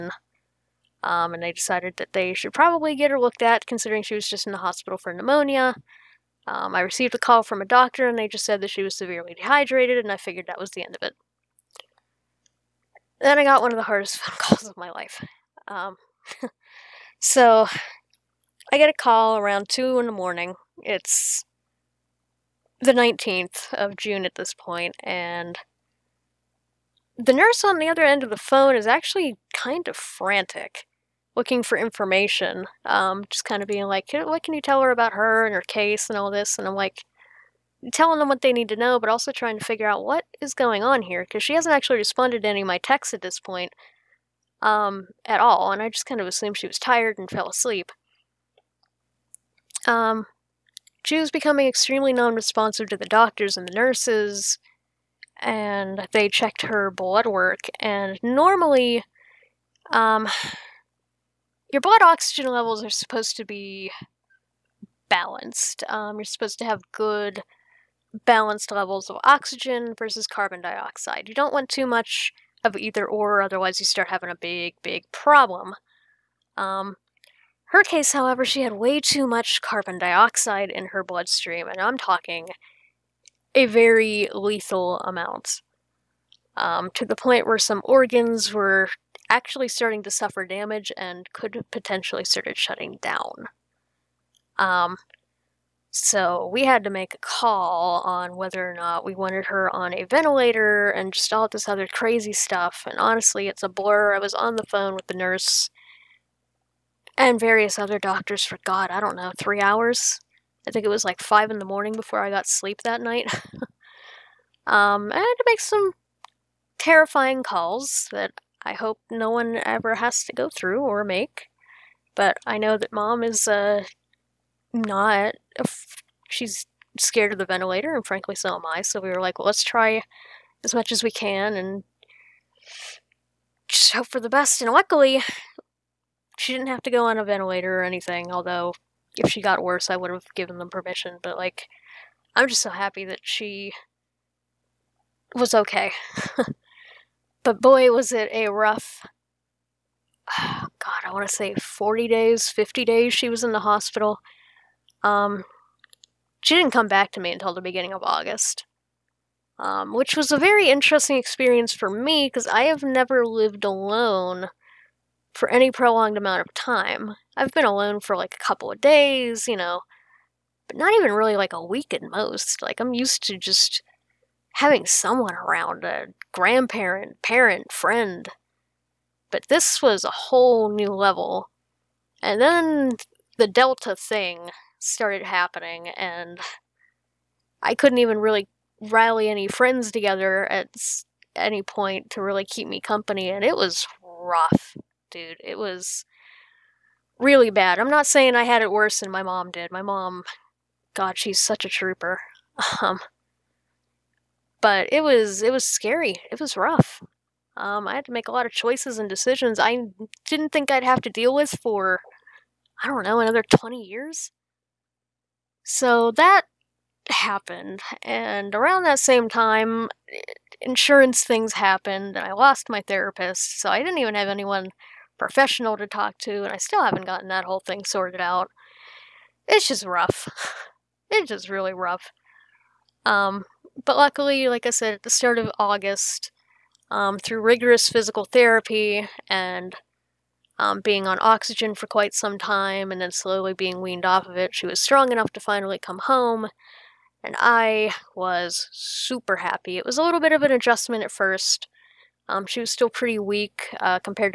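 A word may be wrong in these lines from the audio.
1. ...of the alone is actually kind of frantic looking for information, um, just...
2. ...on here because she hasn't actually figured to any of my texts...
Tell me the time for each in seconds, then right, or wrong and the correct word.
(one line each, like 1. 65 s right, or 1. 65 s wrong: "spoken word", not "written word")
1. 28 s wrong: "phone", not "alone"
2. 40 s wrong: "responded", not "figured".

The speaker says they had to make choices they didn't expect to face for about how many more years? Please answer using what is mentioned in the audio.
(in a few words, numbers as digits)
20 years.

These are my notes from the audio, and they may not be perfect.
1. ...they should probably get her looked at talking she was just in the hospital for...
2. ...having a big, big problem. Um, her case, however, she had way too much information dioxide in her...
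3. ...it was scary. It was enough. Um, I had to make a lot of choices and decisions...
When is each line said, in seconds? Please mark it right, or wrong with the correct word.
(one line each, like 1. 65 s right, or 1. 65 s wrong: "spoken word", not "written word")
1. 2 s wrong: "considering", not "talking"
2. 74 s wrong: "carbon", not "information"
3. 205 s wrong: "rough", not "enough".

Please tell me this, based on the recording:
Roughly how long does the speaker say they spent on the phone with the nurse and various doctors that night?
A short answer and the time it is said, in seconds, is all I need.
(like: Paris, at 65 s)
3 hours, at 109 s.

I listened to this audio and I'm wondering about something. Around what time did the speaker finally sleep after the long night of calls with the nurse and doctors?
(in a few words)
5 in the morning.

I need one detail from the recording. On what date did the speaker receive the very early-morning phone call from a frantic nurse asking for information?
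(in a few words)
19th of June.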